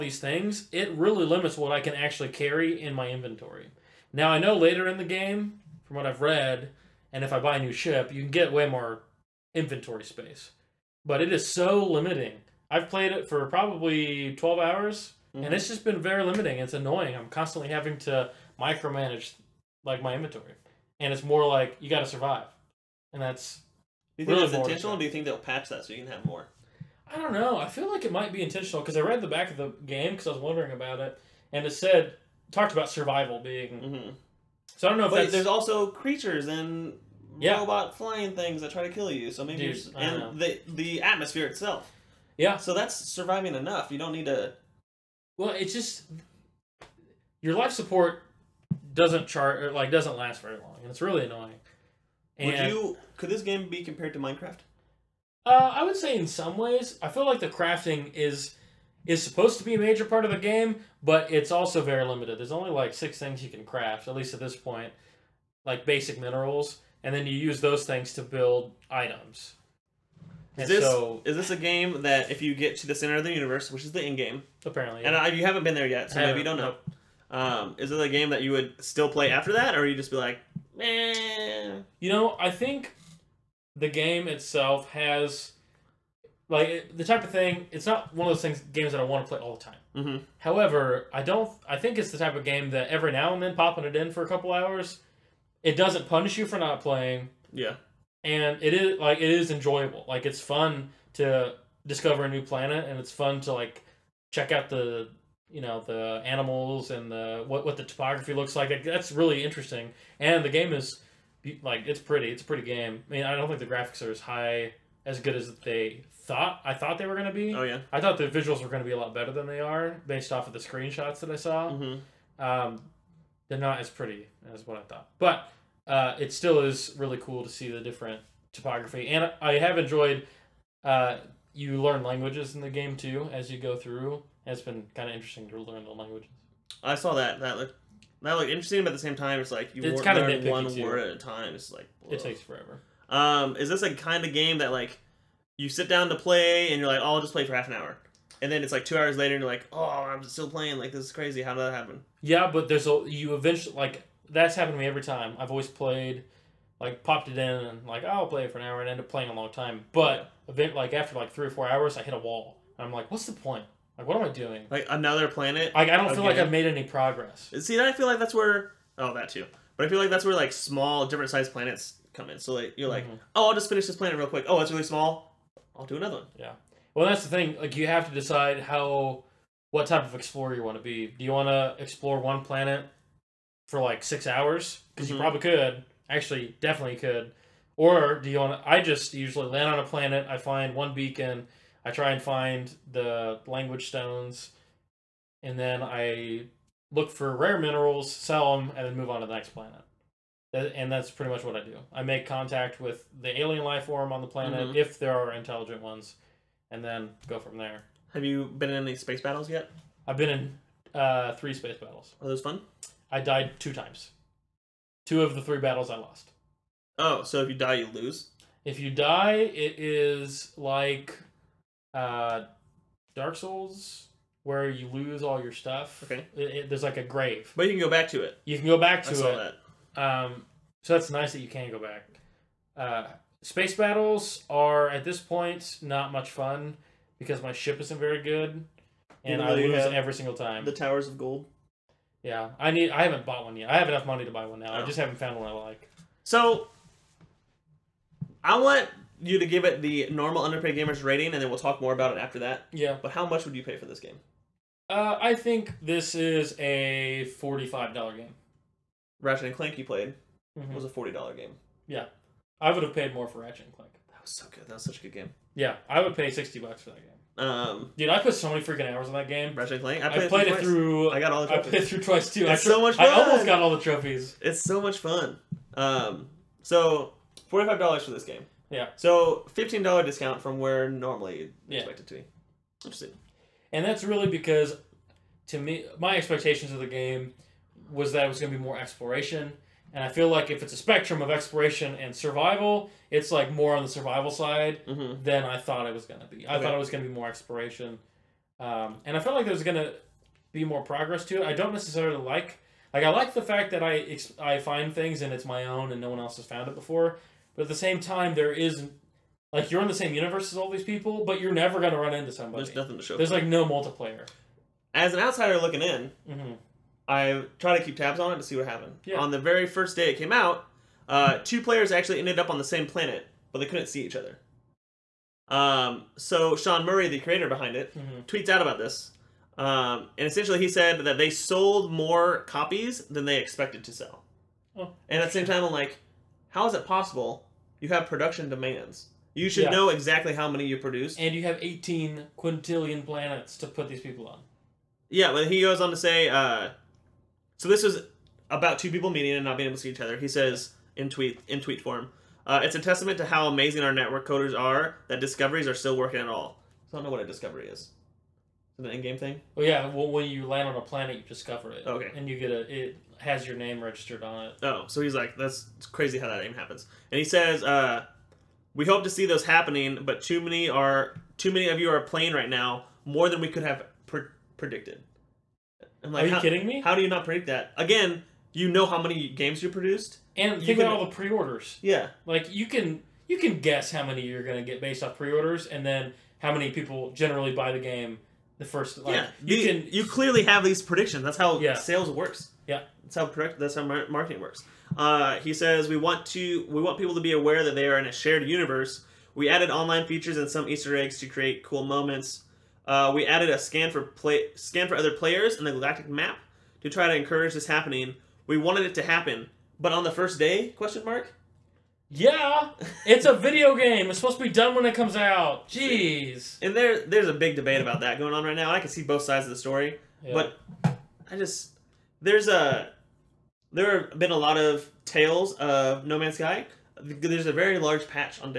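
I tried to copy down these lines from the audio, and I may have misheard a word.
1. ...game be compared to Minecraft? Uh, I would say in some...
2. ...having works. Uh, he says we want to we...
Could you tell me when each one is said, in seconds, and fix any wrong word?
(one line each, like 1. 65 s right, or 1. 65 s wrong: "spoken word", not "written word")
1. 53 s right
2. 393 s wrong: "marketing", not "having".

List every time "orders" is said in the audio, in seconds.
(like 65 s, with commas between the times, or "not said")
381 s, 385 s.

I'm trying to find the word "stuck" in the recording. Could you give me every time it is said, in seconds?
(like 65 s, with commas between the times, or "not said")
not said.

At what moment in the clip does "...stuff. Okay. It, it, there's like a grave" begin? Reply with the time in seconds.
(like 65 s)
225 s.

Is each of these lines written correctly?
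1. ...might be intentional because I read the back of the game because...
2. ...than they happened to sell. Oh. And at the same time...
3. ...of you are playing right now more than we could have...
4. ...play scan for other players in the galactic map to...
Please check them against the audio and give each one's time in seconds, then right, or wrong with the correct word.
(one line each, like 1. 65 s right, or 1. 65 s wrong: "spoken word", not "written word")
1. 28 s right
2. 333 s wrong: "expected", not "happened"
3. 371 s right
4. 404 s right.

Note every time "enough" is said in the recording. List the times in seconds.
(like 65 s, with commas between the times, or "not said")
43 s, 243 s.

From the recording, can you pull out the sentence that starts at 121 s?
hmm Um, they're not as pretty as what I thought, but uh, it still is really cool to see the different topography.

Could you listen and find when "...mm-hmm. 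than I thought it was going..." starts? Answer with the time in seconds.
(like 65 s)
294 s.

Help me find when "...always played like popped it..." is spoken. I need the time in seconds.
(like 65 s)
155 s.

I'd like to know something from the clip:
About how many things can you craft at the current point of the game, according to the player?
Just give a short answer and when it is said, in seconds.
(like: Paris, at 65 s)
6, at 62 s.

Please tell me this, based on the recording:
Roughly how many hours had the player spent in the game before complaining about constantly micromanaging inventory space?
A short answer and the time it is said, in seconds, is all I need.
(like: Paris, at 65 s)
12 hours, at 14 s.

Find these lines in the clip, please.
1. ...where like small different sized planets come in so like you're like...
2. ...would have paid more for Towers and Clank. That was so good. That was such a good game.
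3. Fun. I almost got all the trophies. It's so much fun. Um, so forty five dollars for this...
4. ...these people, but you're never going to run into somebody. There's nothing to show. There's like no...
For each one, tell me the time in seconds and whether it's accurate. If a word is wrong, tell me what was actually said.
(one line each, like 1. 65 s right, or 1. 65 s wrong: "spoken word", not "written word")
1. 170 s right
2. 262 s wrong: "Ratchet", not "Towers"
3. 272 s right
4. 310 s right.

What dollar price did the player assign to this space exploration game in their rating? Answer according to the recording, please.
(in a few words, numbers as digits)
$45.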